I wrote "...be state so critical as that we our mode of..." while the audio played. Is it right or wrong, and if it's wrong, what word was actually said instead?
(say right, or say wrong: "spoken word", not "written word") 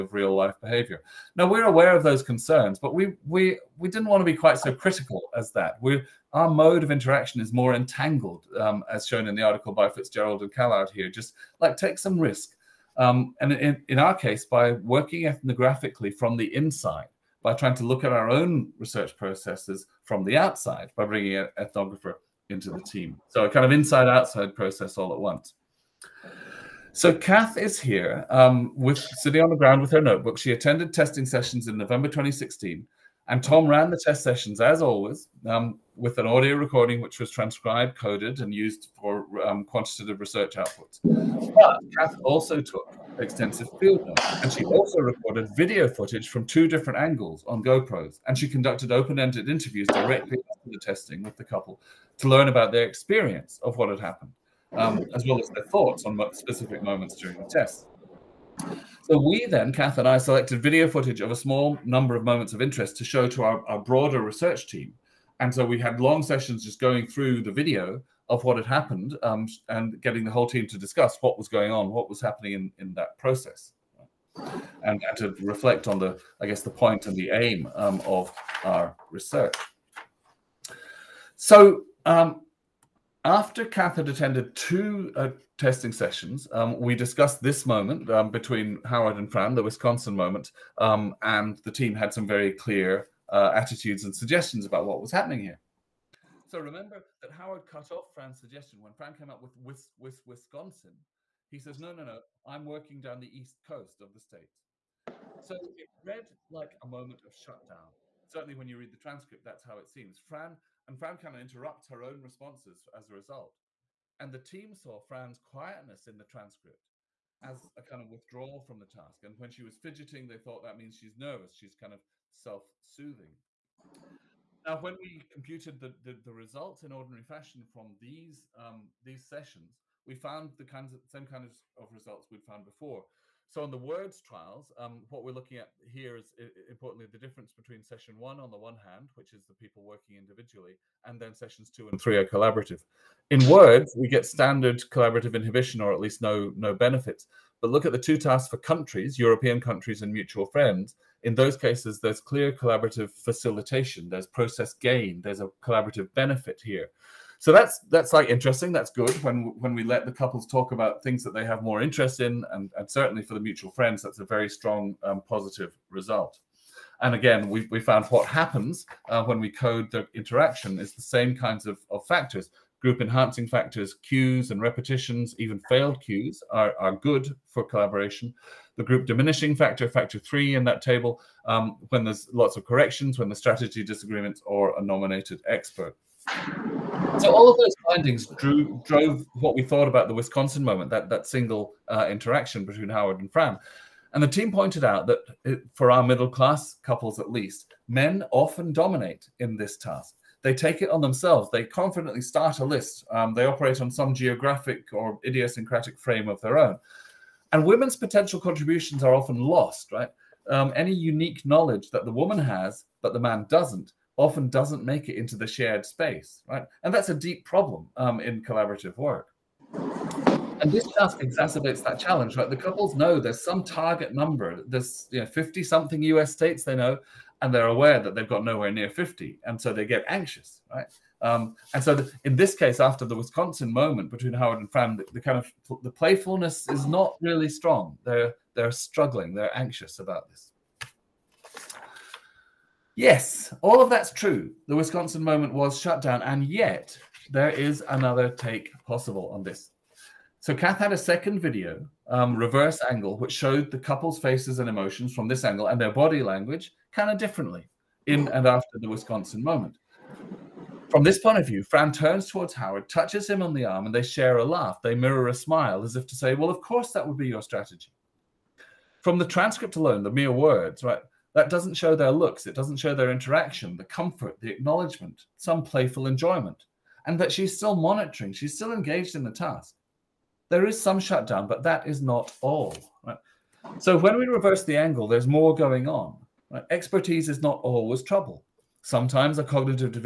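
wrong: "quite", not "state".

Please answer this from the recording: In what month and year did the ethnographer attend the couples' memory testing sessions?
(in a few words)
November 2016.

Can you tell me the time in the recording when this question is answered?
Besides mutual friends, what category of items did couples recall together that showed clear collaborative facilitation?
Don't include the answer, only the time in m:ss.
2:29.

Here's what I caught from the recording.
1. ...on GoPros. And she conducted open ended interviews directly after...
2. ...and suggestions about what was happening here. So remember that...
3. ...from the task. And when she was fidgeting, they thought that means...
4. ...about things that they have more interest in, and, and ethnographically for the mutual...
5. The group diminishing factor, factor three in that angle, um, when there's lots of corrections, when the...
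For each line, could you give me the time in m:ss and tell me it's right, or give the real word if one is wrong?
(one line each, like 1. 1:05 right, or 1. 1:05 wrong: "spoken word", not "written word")
1. 0:47 right
2. 1:34 right
3. 1:58 right
4. 2:40 wrong: "certainly", not "ethnographically"
5. 2:58 wrong: "table", not "angle".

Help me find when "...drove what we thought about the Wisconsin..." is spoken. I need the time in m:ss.
3:08.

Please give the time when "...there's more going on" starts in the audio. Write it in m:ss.
4:45.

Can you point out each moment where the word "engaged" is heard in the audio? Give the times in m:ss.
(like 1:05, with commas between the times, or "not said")
4:38.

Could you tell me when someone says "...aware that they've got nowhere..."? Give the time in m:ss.
3:47.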